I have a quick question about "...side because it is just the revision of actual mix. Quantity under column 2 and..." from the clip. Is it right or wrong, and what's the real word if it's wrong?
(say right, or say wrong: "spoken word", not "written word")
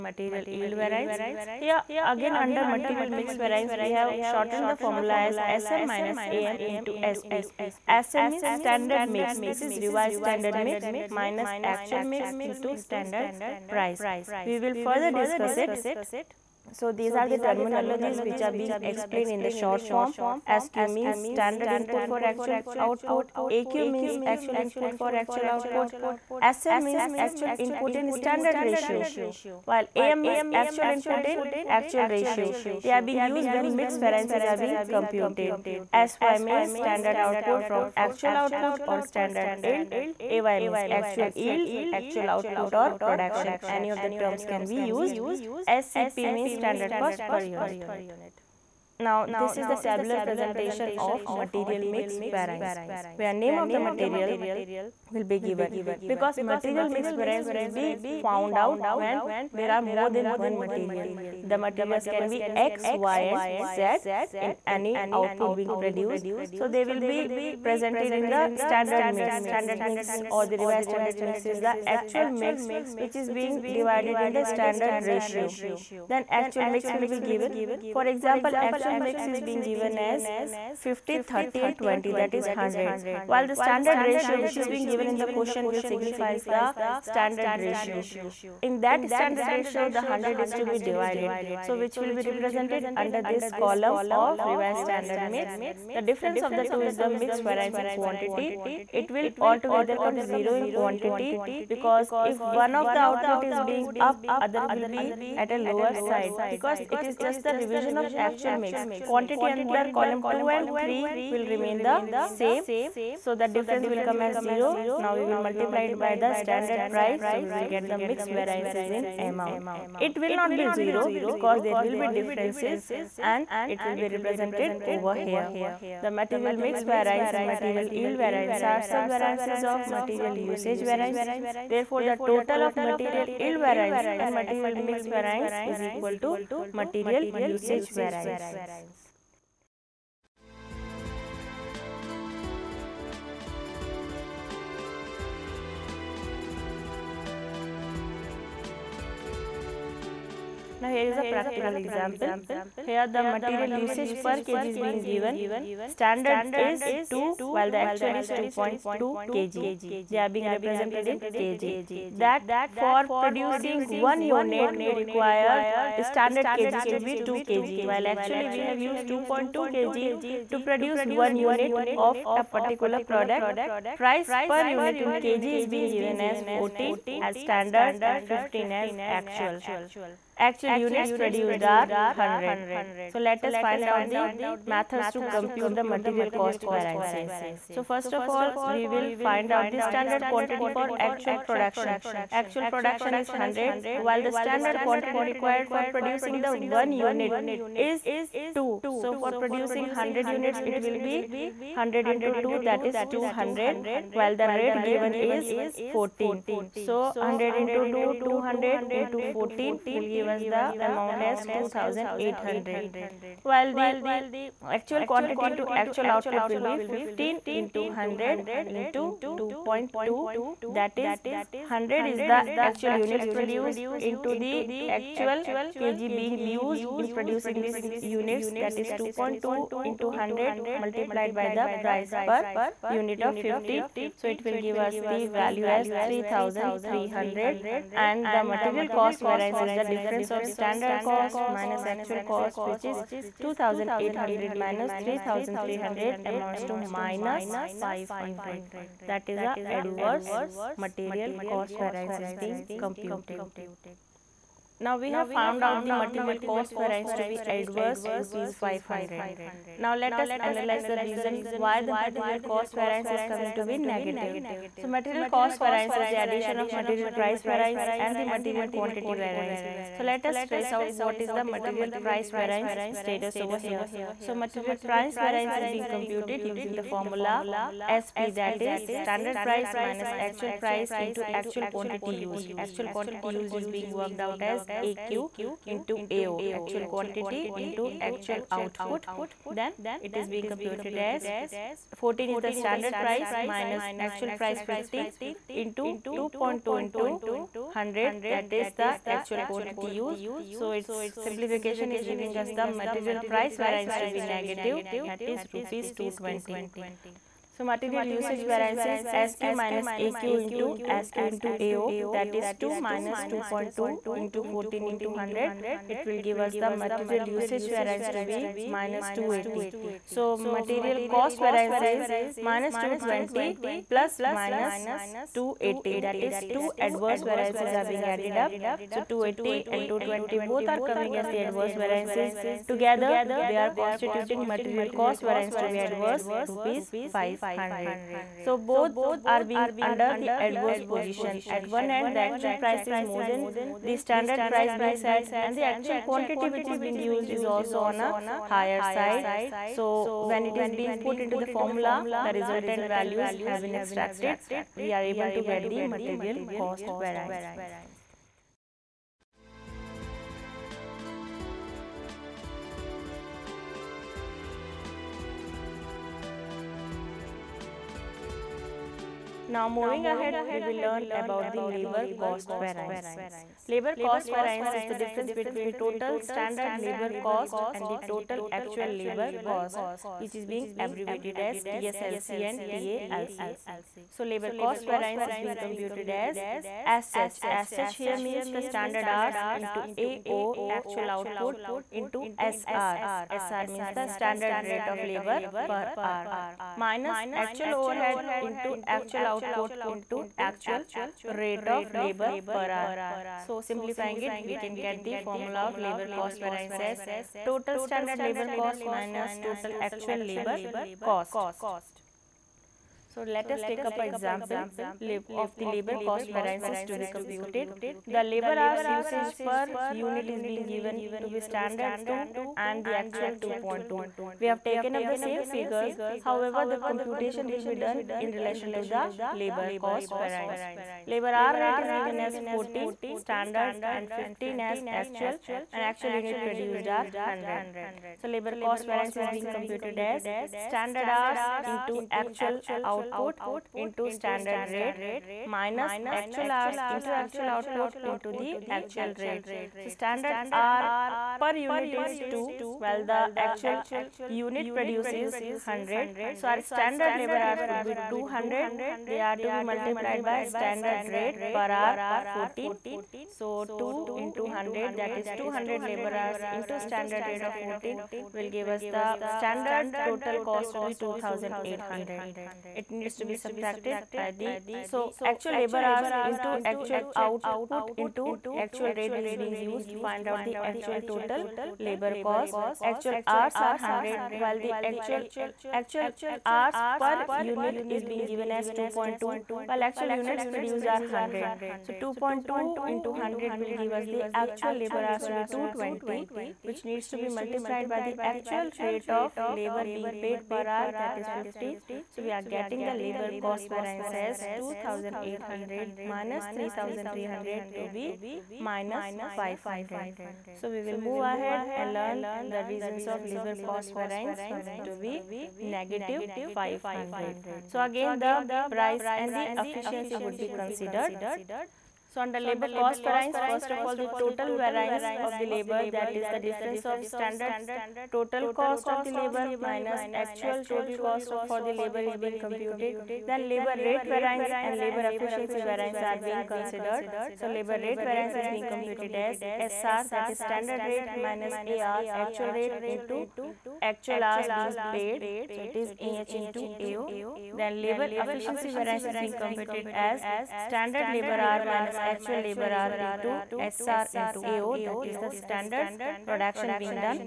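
right.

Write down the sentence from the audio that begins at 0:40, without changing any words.
AY means actual yield, actual output or production.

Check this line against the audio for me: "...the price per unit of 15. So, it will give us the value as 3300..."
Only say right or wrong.
right.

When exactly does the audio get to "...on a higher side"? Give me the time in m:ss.
5:47.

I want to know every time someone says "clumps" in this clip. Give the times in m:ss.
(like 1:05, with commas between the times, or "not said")
not said.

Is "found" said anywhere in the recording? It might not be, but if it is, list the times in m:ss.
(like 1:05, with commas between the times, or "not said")
0:58, 4:15.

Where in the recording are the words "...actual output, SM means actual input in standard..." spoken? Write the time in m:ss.
0:25.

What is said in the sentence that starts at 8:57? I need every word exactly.
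So, labor rate variance is being computed as SR that is standard rate minus AR actual rate into actual hours being paid.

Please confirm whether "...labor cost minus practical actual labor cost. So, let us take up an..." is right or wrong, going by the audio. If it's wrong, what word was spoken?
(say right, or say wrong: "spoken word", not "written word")
wrong: "total", not "practical".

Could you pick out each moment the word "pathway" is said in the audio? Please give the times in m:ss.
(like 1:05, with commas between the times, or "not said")
not said.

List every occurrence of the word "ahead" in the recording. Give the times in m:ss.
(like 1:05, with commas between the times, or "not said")
6:10, 8:31.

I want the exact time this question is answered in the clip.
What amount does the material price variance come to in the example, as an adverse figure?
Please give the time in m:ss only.
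5:05.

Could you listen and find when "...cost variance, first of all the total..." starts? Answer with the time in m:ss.
8:42.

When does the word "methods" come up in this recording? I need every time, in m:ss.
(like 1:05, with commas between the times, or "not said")
3:04.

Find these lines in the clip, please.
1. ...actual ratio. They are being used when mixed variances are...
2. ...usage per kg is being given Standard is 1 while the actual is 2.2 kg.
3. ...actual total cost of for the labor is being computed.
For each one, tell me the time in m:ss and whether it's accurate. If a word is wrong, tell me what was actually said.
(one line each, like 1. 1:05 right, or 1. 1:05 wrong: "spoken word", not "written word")
1. 0:31 right
2. 2:33 wrong: "2", not "1"
3. 8:50 right.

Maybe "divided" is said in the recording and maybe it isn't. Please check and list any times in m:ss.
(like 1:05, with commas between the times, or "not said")
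1:13, 1:30.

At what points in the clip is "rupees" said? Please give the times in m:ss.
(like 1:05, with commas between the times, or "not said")
4:18, 5:05, 5:36.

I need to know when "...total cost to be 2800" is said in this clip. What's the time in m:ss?
7:50.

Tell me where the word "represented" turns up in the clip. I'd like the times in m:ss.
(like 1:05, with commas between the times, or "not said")
1:32, 2:04, 2:40.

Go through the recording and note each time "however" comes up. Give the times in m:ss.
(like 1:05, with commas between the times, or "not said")
7:06.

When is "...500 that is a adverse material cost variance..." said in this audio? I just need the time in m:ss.
4:07.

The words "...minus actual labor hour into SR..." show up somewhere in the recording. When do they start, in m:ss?
9:11.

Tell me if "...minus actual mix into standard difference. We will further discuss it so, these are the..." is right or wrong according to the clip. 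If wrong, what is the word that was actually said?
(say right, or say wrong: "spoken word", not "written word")
wrong: "price", not "difference".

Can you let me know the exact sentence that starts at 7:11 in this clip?
Labor hour rate is given as 14 standard and 15 as actual and actual unit produced are 100.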